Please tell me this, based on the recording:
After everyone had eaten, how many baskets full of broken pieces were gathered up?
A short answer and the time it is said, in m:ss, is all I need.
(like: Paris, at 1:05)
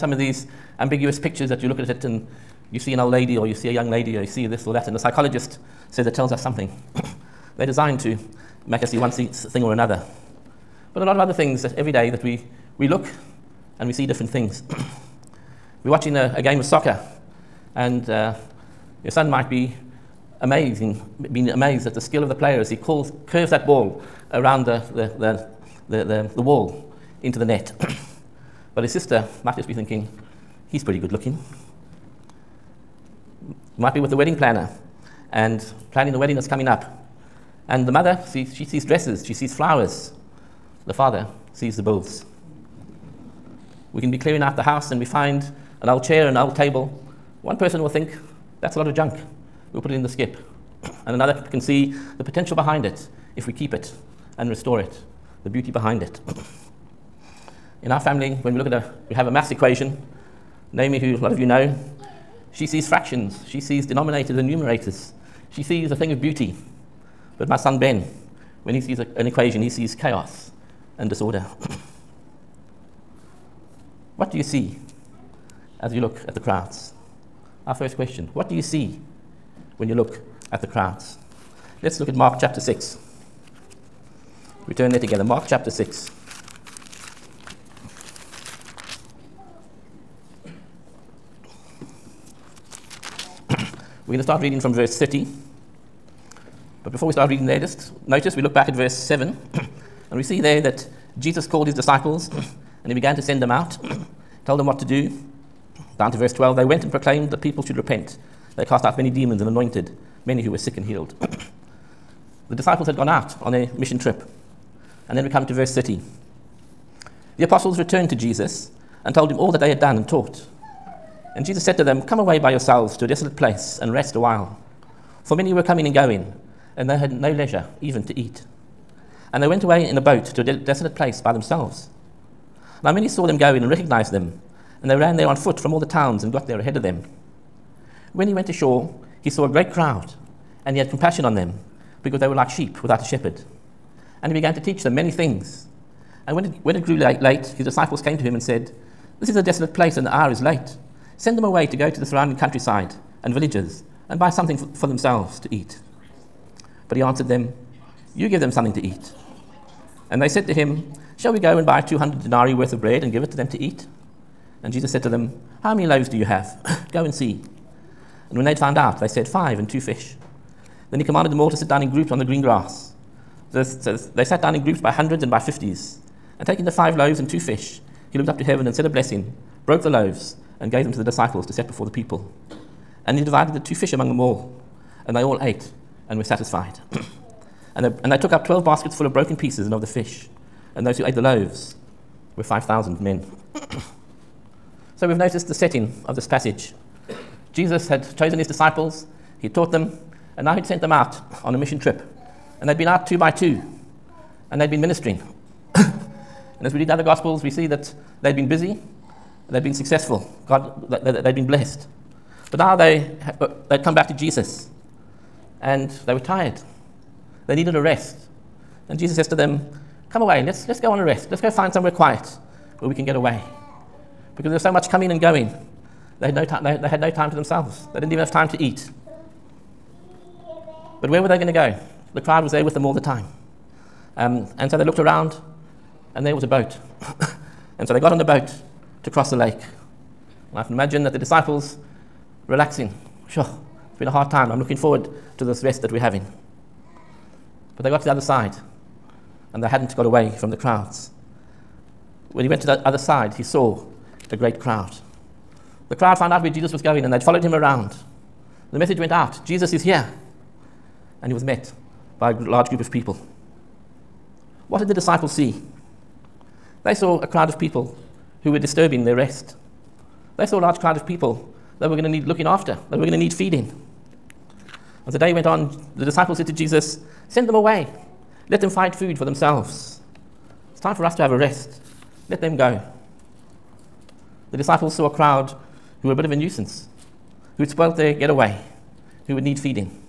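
12, at 3:08.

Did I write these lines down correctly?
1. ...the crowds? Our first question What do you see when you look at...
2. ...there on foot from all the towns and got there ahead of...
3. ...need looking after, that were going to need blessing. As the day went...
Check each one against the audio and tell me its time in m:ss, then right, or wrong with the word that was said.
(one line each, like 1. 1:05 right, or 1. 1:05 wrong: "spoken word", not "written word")
1. 1:16 right
2. 2:15 right
3. 4:32 wrong: "feeding", not "blessing".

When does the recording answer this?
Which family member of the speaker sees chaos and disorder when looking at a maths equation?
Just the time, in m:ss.
1:07.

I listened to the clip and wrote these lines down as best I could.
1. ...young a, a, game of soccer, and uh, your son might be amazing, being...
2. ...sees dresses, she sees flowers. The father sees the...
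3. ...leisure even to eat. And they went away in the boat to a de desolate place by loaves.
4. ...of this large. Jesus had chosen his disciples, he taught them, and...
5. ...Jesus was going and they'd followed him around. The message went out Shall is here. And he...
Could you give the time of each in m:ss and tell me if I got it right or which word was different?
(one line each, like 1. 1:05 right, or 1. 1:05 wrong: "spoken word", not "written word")
1. 0:15 wrong: "watching", not "young"
2. 0:38 right
3. 2:07 wrong: "themselves", not "loaves"
4. 3:16 wrong: "passage", not "large"
5. 4:16 wrong: "Jesus", not "Shall".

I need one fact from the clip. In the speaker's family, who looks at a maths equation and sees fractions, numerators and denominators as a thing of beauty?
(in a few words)
Naomi.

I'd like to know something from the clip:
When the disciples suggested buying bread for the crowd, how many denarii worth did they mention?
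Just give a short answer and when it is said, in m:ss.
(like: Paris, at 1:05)
200, at 2:41.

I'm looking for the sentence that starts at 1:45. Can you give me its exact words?
Down to verse 12 they went and proclaimed that people should repent.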